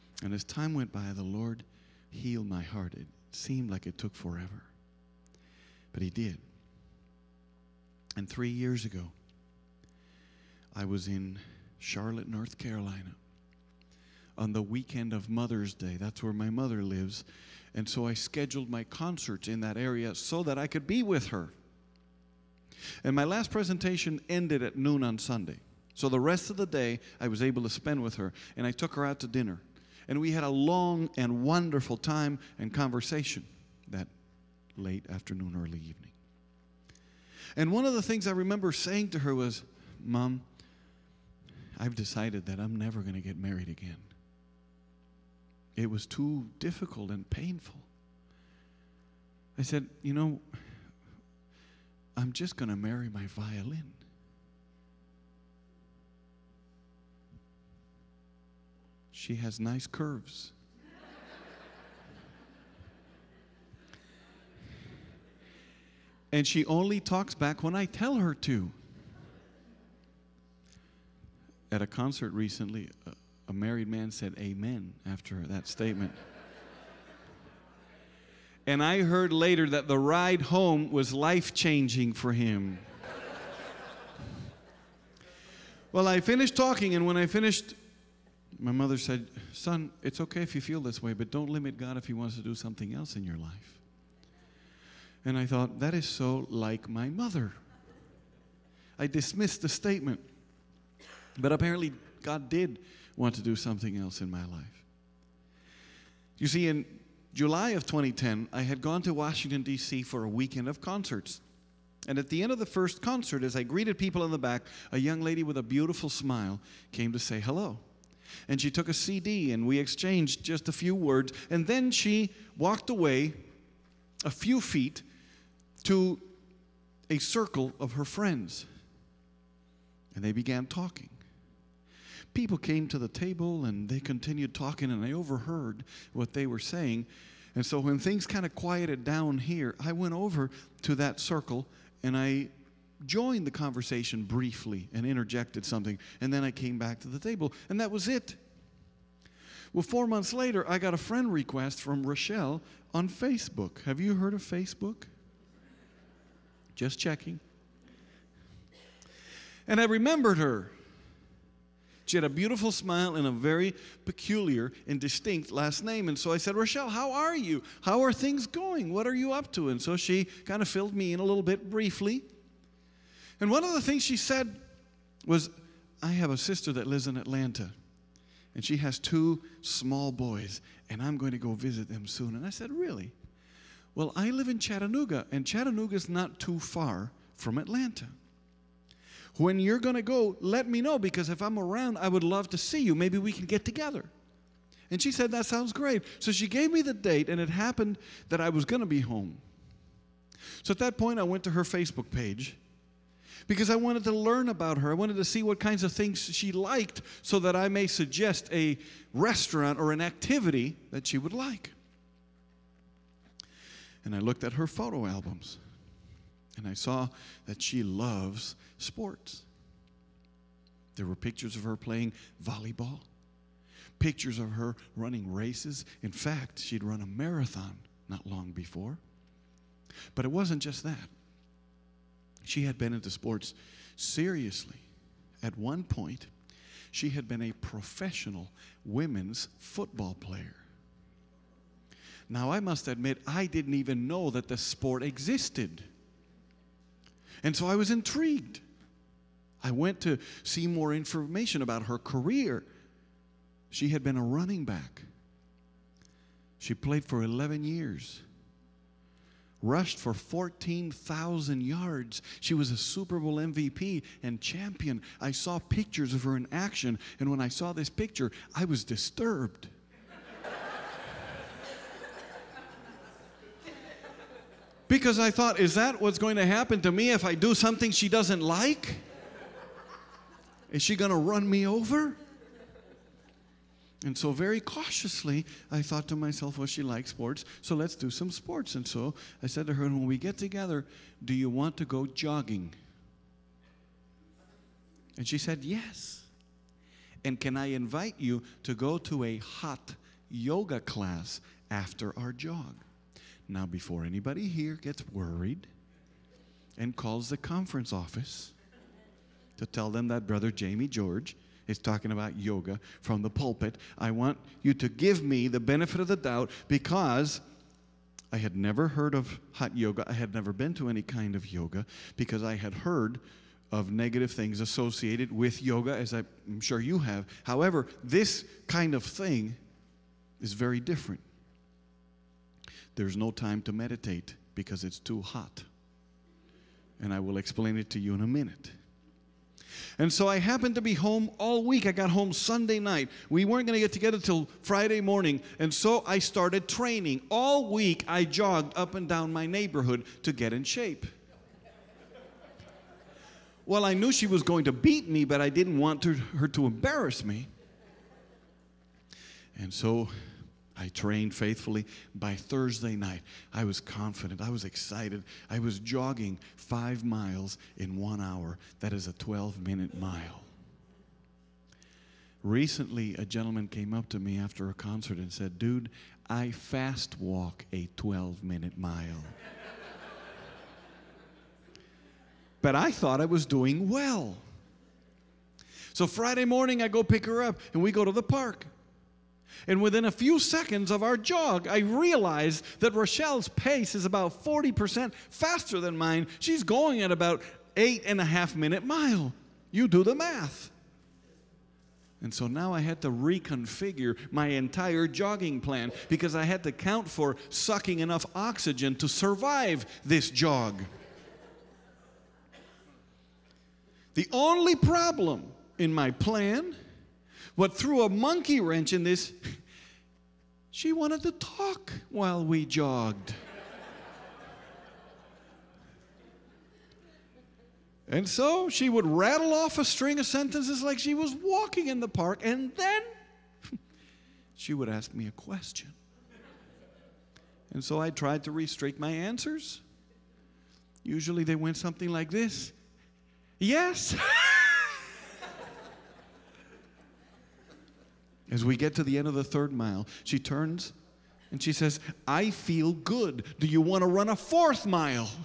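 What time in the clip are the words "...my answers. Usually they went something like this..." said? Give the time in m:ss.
7:18.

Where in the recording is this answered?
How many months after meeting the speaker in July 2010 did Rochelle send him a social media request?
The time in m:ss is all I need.
2:29.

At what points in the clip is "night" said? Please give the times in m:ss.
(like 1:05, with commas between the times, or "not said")
5:42, 6:02.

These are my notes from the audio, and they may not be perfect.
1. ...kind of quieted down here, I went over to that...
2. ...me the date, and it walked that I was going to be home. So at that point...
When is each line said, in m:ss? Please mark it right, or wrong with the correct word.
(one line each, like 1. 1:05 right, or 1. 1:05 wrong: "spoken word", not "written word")
1. 2:18 right
2. 3:16 wrong: "happened", not "walked".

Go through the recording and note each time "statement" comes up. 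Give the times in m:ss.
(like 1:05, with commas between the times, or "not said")
1:15, 1:39.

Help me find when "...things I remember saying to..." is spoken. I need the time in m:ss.
0:38.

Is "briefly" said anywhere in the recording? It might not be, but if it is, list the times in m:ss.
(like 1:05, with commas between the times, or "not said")
2:24, 2:51.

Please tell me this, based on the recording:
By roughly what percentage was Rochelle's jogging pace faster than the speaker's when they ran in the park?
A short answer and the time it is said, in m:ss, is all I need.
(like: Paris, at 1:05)
40%, at 6:34.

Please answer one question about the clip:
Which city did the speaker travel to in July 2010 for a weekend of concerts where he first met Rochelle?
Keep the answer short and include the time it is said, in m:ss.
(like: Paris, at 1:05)
Washington, D.C., at 1:49.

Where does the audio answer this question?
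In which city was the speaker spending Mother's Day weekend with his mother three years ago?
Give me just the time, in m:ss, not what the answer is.
0:11.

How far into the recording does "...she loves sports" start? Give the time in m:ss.
3:37.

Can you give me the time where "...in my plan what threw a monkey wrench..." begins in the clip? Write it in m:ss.
6:55.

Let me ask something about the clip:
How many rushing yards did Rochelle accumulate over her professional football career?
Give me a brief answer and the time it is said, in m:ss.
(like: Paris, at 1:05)
14,000, at 4:20.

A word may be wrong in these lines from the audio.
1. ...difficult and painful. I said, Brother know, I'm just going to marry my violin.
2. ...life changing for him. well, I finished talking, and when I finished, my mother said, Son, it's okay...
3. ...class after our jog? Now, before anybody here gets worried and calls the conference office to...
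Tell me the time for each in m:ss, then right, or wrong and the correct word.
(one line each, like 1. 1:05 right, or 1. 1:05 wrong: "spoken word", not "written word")
1. 0:46 wrong: "You", not "Brother"
2. 1:21 right
3. 5:00 right.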